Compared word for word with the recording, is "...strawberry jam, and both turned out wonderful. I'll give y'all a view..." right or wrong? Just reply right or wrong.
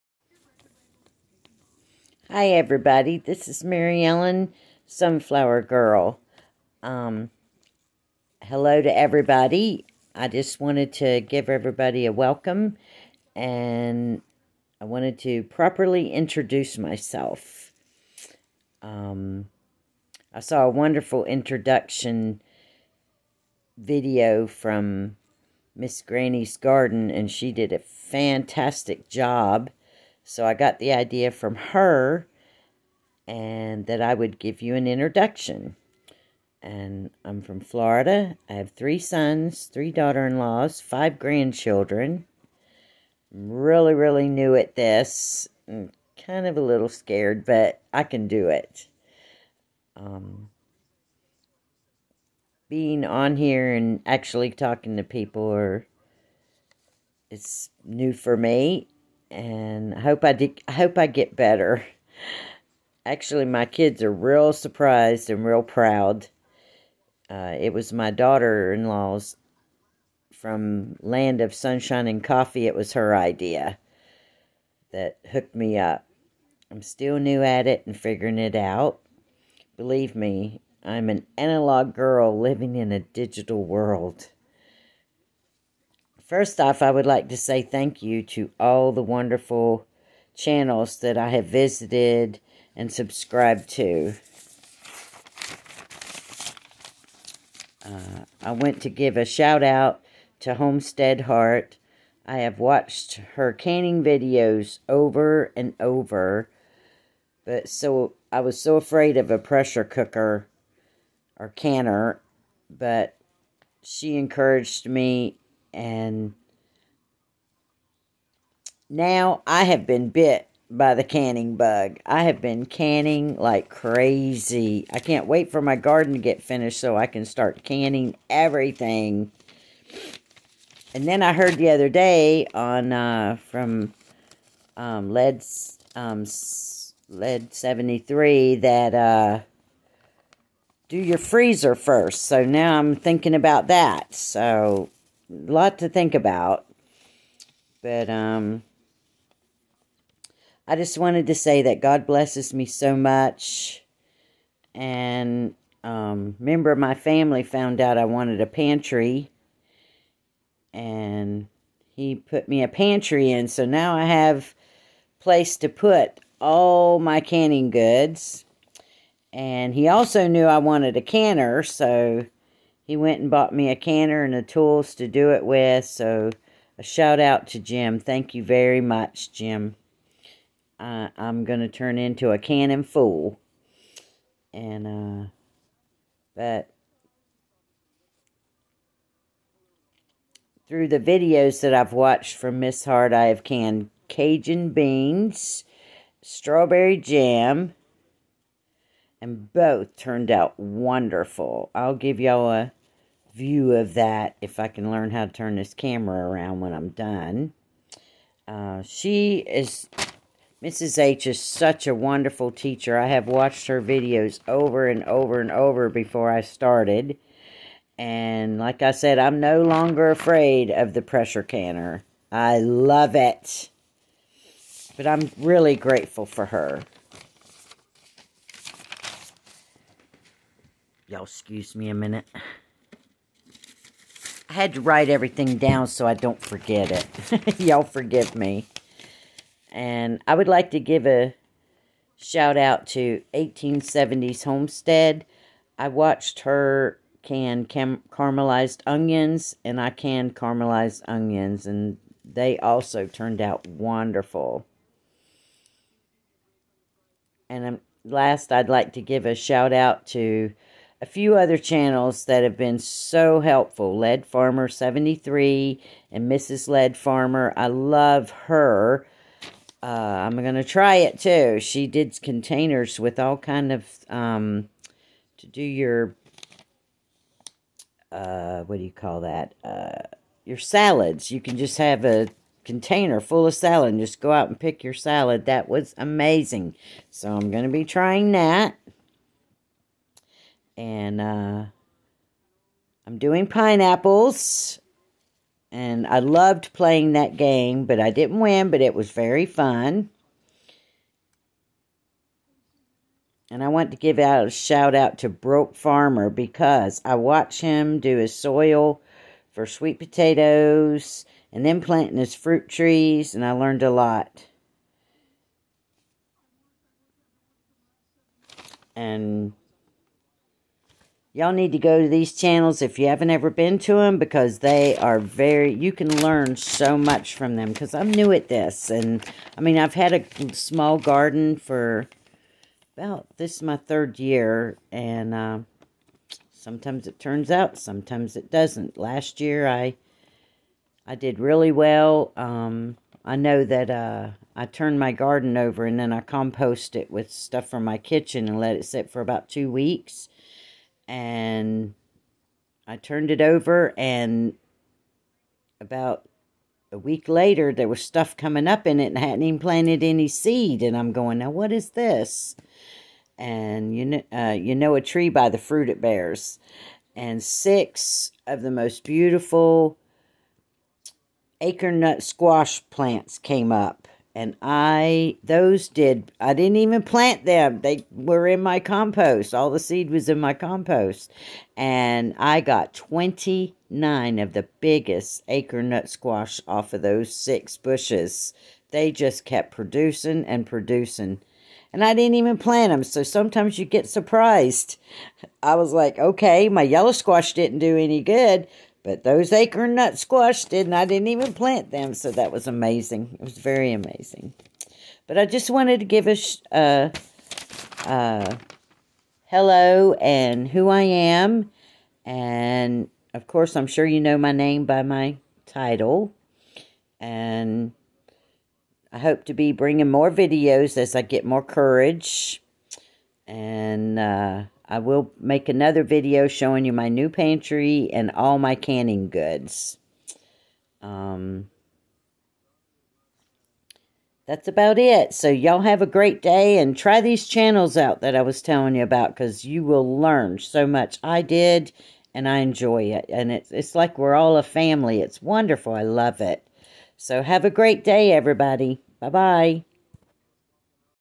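right.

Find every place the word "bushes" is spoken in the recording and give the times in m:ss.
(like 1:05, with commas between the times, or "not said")
6:27.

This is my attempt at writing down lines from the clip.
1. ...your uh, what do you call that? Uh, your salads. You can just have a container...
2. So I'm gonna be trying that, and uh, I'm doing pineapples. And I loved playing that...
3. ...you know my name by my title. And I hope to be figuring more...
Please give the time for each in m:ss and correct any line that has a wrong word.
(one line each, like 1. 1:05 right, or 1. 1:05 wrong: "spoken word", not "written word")
1. 4:35 right
2. 4:47 right
3. 6:54 wrong: "bringing", not "figuring".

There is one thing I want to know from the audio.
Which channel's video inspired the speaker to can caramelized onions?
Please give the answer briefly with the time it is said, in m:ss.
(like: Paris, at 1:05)
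1870s Homestead, at 4:03.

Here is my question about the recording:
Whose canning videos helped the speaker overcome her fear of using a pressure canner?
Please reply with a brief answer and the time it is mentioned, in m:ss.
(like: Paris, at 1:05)
Homestead Heart, at 1:40.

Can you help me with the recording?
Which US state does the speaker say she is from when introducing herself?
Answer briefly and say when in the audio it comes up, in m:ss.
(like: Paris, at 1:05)
Florida, at 0:37.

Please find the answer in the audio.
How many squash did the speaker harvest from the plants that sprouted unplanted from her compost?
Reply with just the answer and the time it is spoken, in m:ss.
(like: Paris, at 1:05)
29, at 6:22.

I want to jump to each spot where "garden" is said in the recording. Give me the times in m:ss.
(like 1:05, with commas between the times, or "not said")
0:26, 2:05, 5:30, 5:45.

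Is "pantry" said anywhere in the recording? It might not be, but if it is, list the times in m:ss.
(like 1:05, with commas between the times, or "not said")
2:38, 2:42, 7:07.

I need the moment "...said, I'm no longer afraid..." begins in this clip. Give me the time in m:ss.
3:38.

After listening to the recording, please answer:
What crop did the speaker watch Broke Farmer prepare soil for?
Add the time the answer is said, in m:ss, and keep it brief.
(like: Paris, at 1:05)
Sweet potatoes, at 5:09.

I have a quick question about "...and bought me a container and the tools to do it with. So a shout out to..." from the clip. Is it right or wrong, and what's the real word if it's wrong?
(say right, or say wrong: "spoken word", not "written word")
wrong: "canner", not "container".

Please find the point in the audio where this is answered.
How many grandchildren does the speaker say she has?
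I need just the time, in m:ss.
0:40.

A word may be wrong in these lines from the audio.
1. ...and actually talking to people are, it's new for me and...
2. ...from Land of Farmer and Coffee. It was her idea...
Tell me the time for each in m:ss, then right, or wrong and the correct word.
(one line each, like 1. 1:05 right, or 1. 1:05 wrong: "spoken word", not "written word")
1. 0:53 right
2. 1:10 wrong: "Sunshine", not "Farmer".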